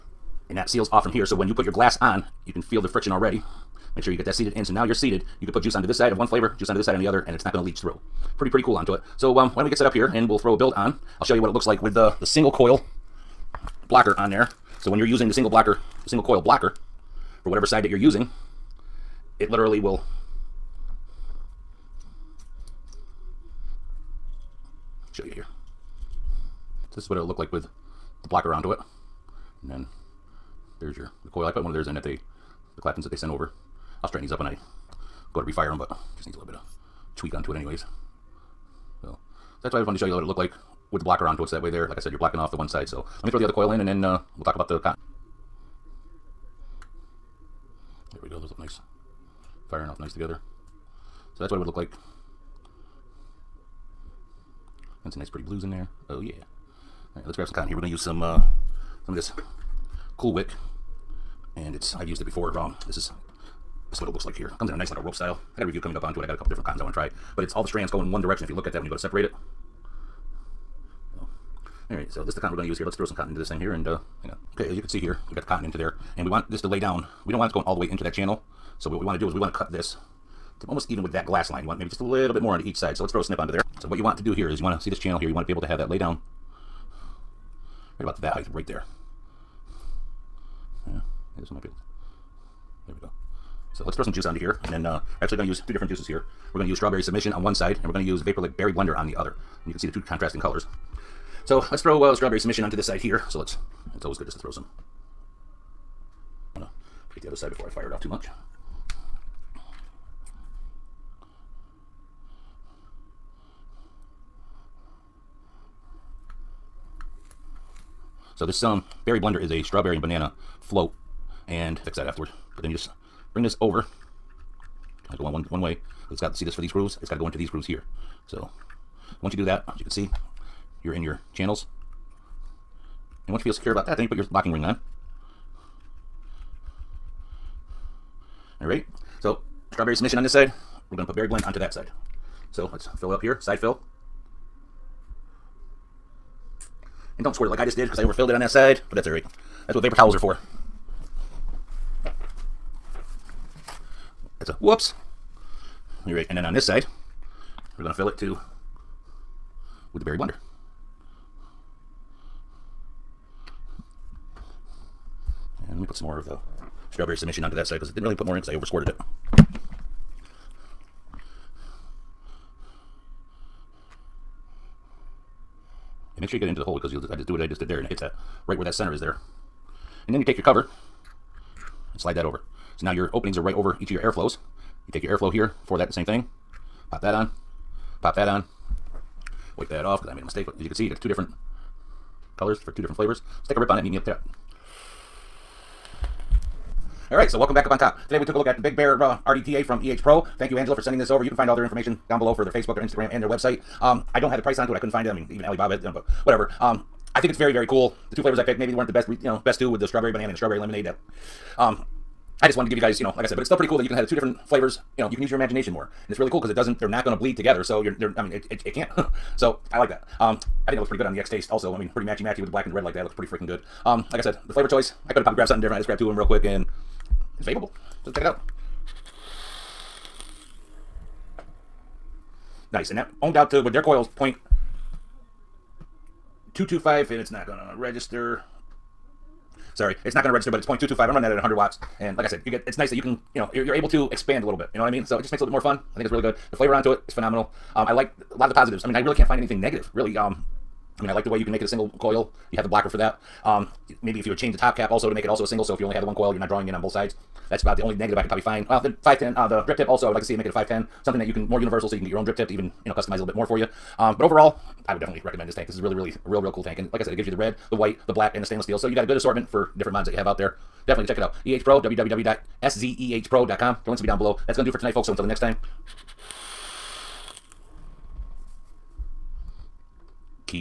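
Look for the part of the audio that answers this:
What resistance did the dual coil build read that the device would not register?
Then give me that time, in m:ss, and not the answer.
4:00.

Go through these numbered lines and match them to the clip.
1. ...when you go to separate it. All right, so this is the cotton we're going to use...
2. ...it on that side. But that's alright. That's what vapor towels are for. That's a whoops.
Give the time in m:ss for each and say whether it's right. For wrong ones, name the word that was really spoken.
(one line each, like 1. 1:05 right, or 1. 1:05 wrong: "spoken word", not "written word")
1. 1:08 right
2. 2:28 right.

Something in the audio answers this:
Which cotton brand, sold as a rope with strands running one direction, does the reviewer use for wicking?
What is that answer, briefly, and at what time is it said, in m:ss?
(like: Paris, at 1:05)
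Cool Wick, at 1:00.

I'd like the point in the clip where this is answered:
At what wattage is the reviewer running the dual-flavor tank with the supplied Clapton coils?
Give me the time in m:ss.
4:01.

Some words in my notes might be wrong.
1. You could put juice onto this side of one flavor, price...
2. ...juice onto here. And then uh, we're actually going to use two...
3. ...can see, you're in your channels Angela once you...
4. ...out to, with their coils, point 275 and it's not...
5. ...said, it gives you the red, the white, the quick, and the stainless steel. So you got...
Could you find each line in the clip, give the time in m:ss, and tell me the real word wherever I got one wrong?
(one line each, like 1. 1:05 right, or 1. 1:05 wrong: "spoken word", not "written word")
1. 0:05 wrong: "juice", not "price"
2. 1:34 right
3. 2:09 wrong: "And", not "Angela"
4. 3:53 wrong: "225", not "275"
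5. 4:27 wrong: "black", not "quick".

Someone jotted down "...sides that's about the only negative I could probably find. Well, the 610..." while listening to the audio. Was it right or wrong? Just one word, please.
wrong.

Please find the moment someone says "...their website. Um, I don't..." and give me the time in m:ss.
3:23.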